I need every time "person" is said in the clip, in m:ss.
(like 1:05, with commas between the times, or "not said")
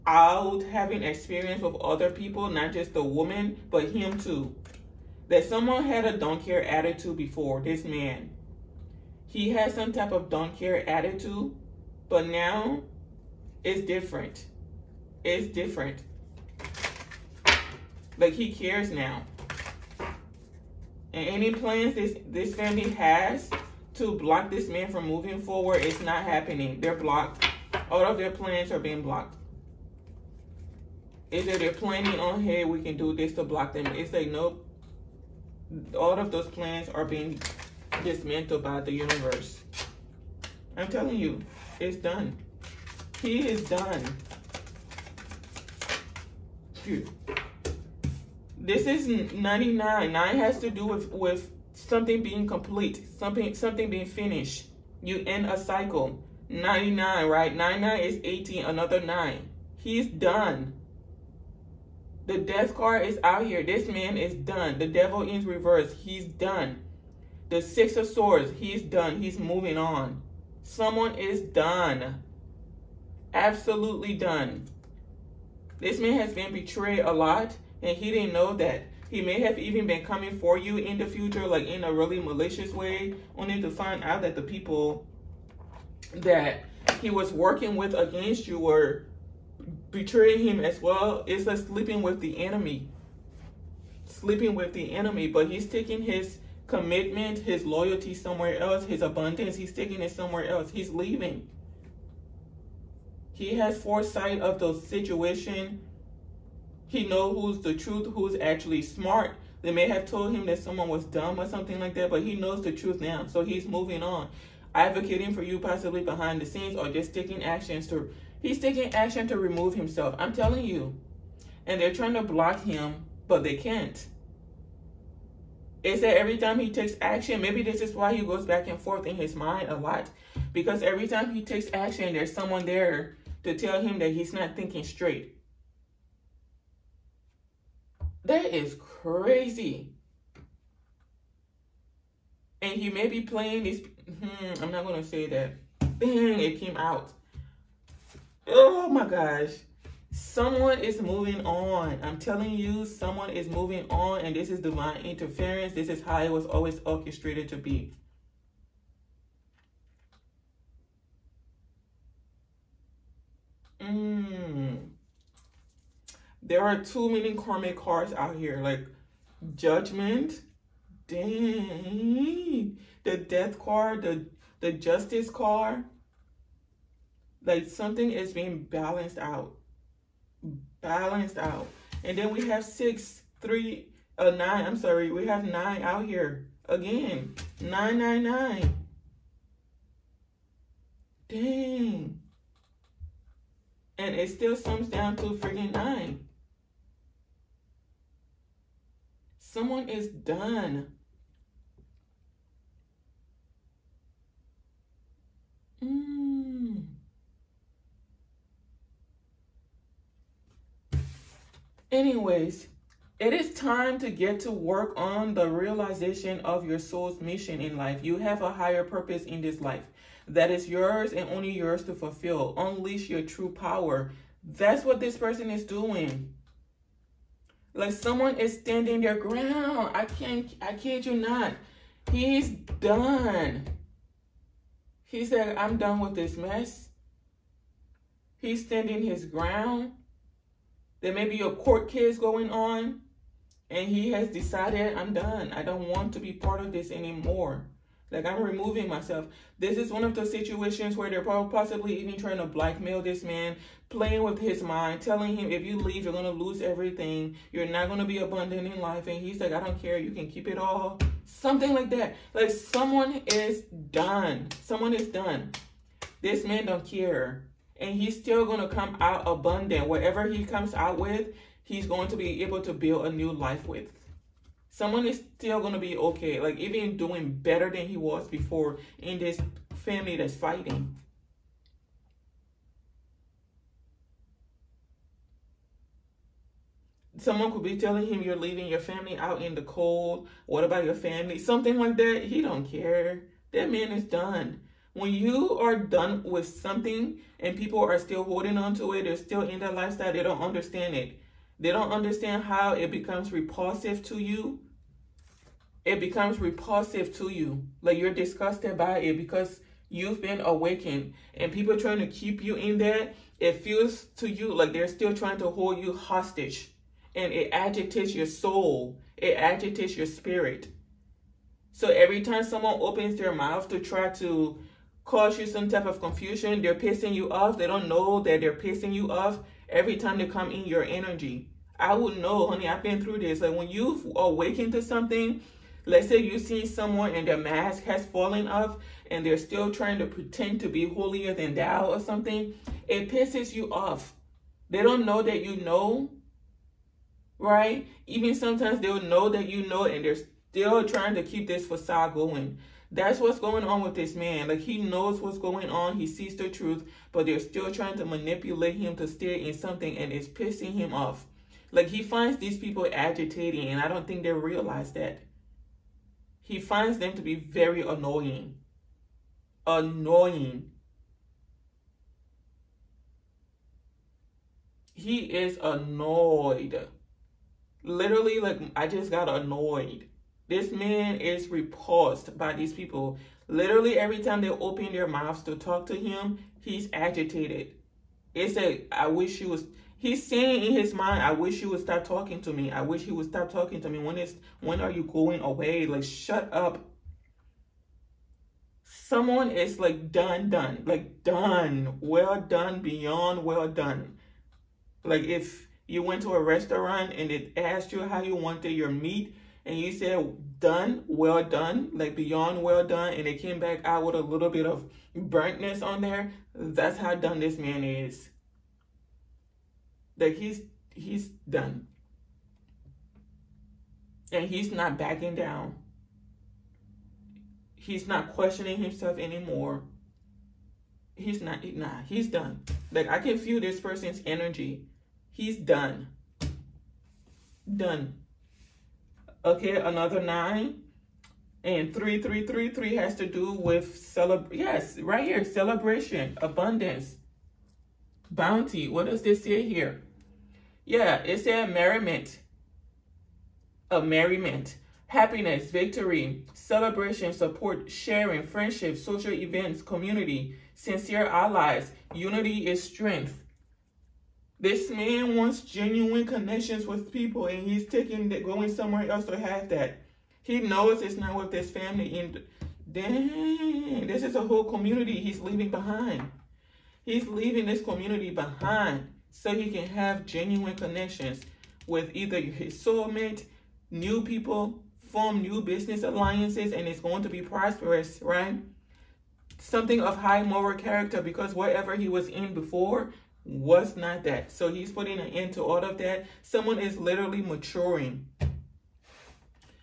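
3:45, 7:13.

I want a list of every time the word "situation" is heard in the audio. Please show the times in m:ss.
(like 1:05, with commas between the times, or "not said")
1:44, 4:10.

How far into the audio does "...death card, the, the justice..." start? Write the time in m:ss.
2:53.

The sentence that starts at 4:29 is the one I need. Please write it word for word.
Whatever he comes out with, he's going to be able to build a new life with.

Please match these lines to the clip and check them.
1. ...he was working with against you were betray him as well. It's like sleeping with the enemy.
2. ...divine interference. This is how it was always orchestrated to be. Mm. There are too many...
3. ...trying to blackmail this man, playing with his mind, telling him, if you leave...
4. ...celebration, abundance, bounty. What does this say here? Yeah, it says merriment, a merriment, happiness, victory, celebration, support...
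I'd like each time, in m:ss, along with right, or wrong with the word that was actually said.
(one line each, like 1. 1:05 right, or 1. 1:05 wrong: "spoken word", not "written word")
1. 1:27 right
2. 2:34 right
3. 4:12 right
4. 7:25 right.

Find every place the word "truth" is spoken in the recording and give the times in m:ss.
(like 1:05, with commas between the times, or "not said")
1:47, 1:52, 5:56.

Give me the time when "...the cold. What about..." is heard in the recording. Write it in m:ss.
4:49.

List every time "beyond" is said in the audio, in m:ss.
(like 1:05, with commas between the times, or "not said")
6:42, 6:52.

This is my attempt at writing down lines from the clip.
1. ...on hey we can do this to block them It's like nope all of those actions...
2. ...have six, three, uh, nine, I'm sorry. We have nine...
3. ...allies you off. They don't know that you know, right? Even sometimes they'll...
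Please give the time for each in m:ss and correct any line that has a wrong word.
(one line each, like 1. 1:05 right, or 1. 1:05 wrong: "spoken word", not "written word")
1. 0:32 wrong: "plans", not "actions"
2. 3:02 right
3. 5:43 wrong: "pisses", not "allies".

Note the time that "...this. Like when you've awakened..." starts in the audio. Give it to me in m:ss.
5:33.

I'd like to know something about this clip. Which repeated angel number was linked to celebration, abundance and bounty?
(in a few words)
3333.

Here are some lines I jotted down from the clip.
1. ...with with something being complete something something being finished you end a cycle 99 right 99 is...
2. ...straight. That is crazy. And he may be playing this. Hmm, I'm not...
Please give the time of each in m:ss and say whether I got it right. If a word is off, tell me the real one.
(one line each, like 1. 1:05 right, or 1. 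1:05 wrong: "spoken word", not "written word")
1. 0:50 right
2. 2:14 right.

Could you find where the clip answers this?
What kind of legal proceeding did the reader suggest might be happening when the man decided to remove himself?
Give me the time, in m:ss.
4:01.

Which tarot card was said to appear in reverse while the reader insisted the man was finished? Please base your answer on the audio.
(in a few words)
The Devil.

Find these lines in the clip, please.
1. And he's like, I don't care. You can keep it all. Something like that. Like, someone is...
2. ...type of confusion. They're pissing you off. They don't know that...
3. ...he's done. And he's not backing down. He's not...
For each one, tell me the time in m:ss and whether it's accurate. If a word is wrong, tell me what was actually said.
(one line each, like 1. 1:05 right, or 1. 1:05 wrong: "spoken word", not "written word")
1. 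4:19 right
2. 5:25 right
3. 7:00 right.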